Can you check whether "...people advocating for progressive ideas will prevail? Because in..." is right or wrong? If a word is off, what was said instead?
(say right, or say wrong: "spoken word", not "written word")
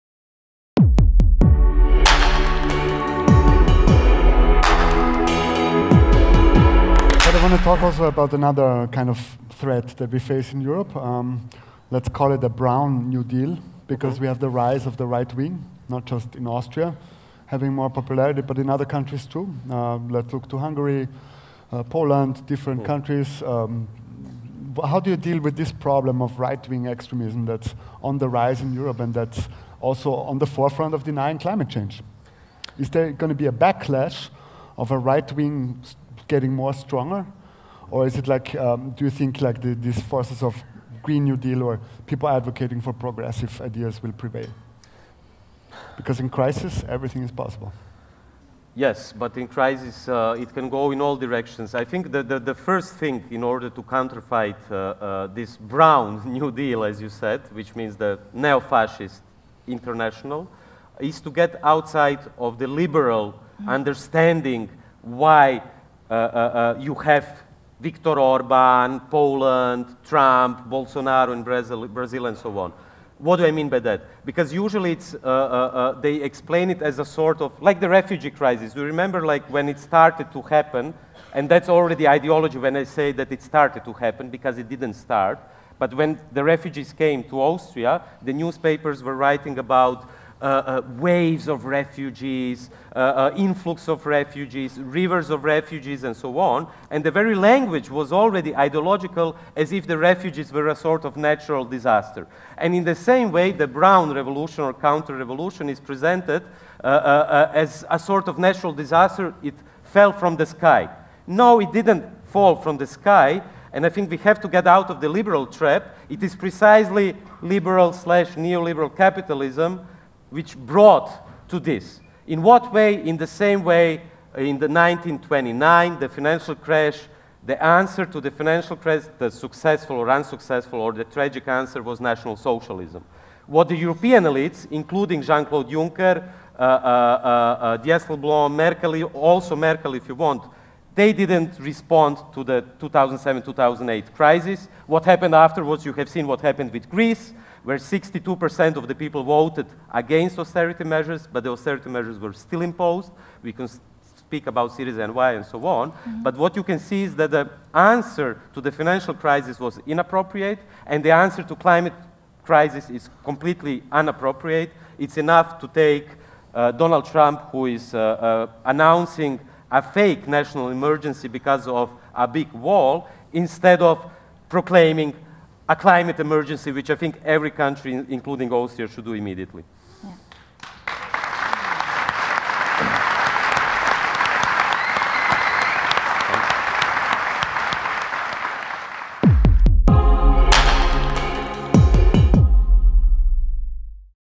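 right.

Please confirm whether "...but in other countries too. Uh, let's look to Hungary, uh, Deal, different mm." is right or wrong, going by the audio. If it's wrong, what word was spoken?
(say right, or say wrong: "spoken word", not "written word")
wrong: "Poland", not "Deal".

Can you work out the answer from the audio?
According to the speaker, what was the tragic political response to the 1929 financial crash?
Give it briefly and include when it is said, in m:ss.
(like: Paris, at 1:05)
National Socialism, at 2:11.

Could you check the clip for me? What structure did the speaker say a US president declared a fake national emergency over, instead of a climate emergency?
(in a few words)
a big wall.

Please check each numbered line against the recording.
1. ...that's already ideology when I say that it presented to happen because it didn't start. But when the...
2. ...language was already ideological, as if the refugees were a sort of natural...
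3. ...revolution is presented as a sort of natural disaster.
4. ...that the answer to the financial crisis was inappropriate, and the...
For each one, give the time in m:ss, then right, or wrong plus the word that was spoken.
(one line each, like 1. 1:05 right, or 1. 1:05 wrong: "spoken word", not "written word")
1. 1:21 wrong: "started", not "presented"
2. 1:37 right
3. 1:45 right
4. 2:37 right.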